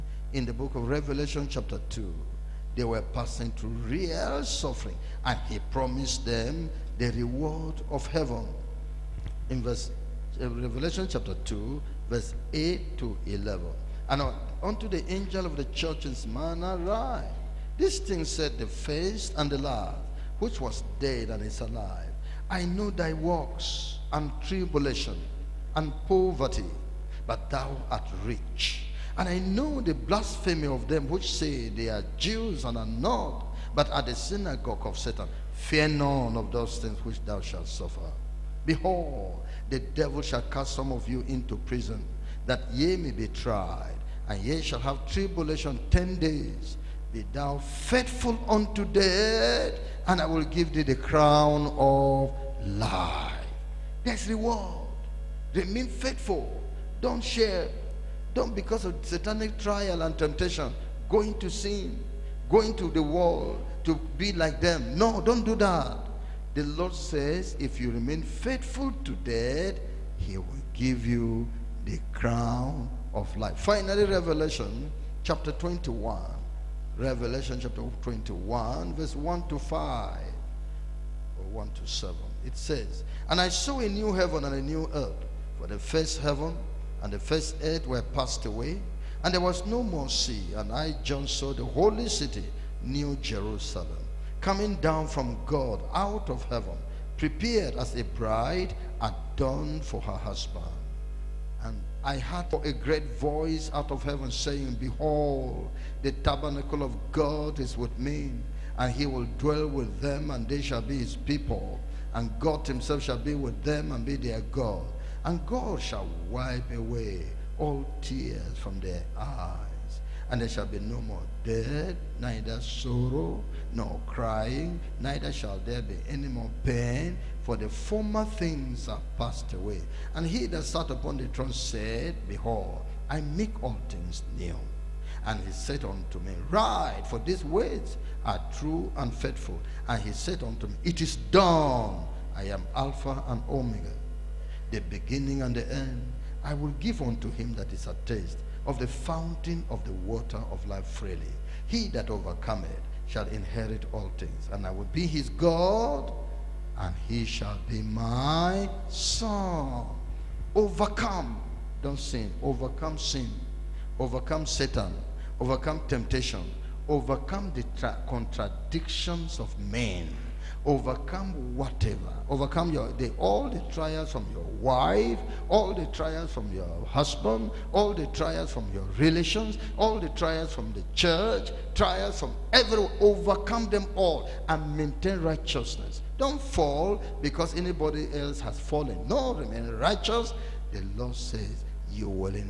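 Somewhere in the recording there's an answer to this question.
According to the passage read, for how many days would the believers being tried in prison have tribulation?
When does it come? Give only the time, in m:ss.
0:45.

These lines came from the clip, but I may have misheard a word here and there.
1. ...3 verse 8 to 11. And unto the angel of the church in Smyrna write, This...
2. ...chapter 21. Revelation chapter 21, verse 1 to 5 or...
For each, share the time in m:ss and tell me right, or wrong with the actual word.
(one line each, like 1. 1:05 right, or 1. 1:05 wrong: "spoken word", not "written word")
1. 0:11 wrong: "2", not "3"
2. 1:15 right.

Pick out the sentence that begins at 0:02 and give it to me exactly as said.
They were passing through real suffering and he promised them the reward of heaven.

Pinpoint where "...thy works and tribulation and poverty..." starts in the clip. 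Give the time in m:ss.
0:22.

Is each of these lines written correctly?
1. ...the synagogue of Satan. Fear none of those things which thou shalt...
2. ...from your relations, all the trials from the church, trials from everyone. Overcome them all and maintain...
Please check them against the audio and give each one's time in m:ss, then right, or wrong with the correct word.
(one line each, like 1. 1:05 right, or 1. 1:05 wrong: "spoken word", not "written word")
1. 0:34 right
2. 2:58 right.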